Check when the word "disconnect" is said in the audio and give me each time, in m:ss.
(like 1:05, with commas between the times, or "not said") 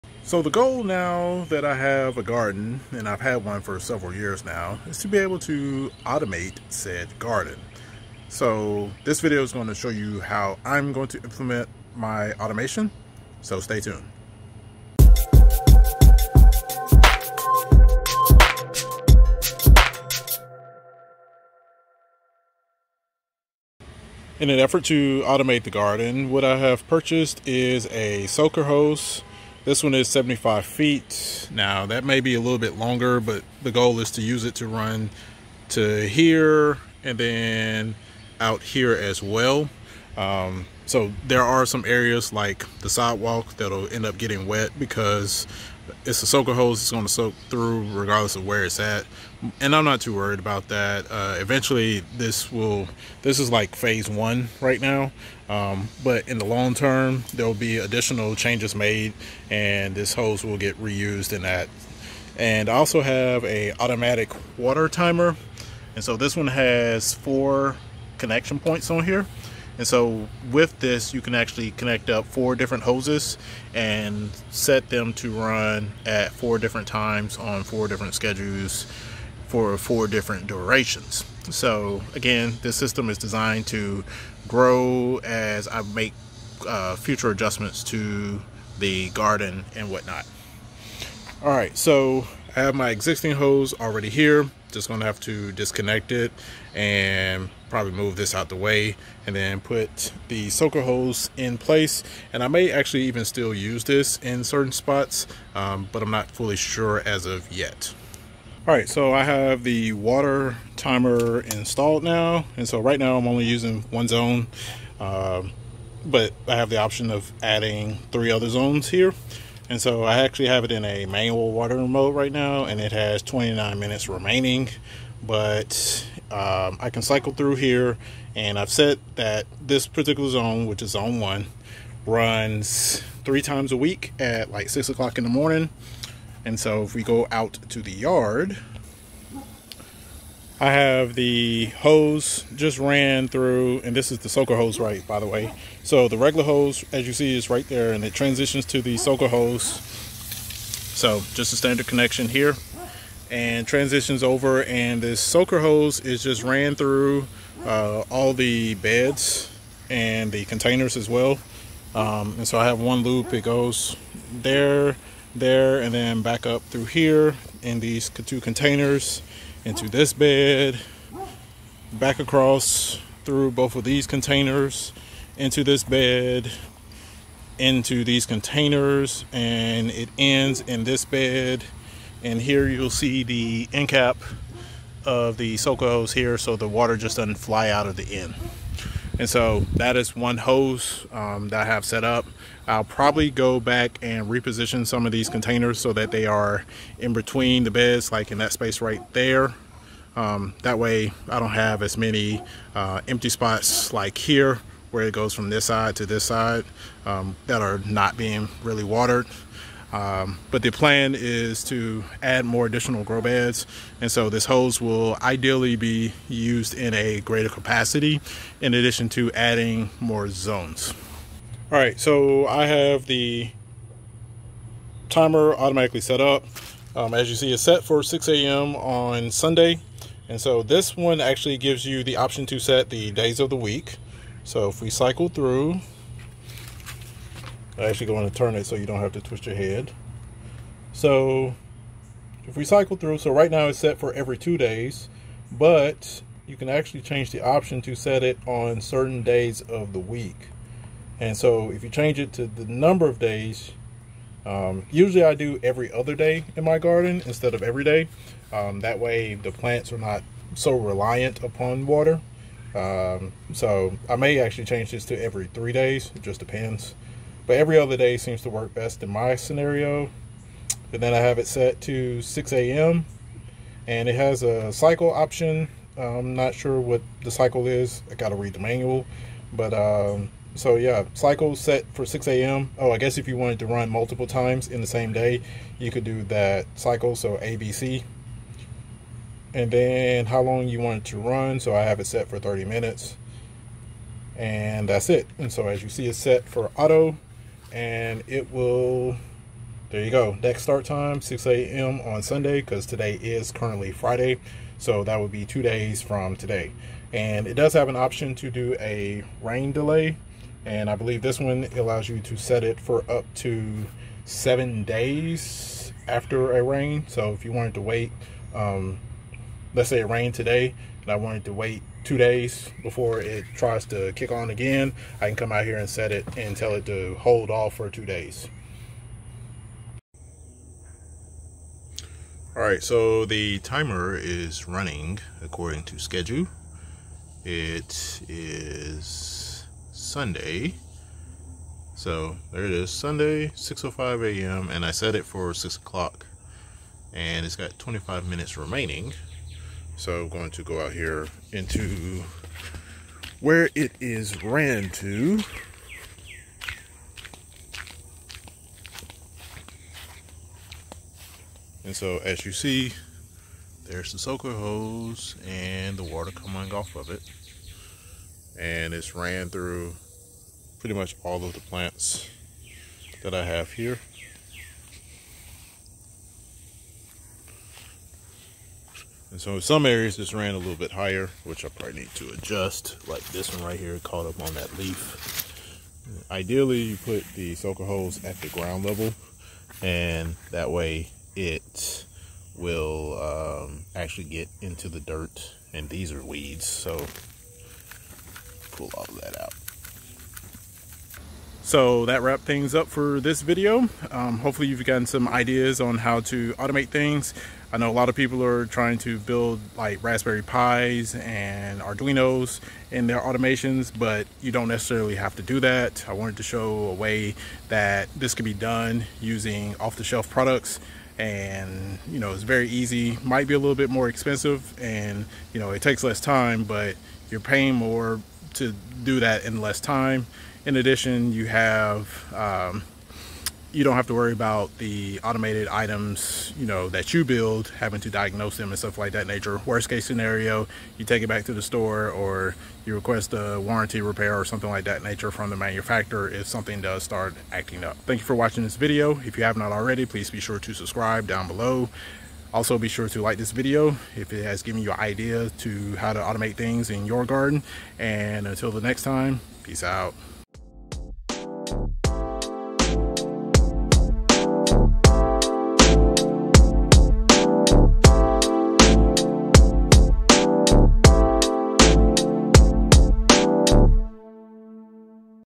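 1:35.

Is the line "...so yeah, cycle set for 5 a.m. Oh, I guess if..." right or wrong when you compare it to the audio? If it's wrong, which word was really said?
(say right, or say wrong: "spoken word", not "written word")
wrong: "6", not "5".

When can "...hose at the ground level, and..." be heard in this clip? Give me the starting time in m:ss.
6:27.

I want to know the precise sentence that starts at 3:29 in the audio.
Um, but the plan is to add more additional grow beds.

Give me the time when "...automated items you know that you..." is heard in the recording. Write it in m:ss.
7:15.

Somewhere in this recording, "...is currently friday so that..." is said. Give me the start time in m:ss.
5:03.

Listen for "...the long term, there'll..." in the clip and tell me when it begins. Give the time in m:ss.
0:56.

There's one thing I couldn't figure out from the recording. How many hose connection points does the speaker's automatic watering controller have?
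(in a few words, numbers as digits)
4.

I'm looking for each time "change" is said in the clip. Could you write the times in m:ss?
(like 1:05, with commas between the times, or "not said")
0:58, 4:07, 4:11, 4:24.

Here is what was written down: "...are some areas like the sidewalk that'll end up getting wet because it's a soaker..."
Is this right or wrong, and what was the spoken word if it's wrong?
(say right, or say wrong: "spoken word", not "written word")
right.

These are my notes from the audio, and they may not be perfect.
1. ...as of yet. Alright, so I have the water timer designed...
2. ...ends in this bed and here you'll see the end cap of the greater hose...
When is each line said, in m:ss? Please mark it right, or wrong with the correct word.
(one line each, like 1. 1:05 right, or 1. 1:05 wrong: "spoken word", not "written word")
1. 1:47 wrong: "installed", not "designed"
2. 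3:00 wrong: "soaker", not "greater".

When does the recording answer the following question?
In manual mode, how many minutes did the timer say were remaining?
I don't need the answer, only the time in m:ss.
2:03.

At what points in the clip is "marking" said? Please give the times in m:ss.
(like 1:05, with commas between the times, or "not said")
not said.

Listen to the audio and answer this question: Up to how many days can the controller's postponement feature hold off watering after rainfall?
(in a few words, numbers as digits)
7 days.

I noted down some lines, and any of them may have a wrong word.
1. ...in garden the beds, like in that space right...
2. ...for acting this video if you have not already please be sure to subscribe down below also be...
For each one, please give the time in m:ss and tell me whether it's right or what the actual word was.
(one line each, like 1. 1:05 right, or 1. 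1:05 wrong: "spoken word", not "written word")
1. 3:16 wrong: "between", not "garden"
2. 7:28 wrong: "watching", not "acting".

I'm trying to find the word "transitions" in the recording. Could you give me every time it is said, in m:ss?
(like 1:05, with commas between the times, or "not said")
2:28, 2:33.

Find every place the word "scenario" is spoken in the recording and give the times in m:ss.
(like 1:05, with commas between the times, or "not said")
4:29, 7:20.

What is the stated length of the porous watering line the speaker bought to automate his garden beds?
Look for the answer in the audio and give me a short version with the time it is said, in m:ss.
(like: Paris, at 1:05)
75 feet, at 0:30.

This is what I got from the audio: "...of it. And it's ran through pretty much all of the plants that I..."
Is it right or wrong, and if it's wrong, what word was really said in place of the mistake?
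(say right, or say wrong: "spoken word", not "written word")
right.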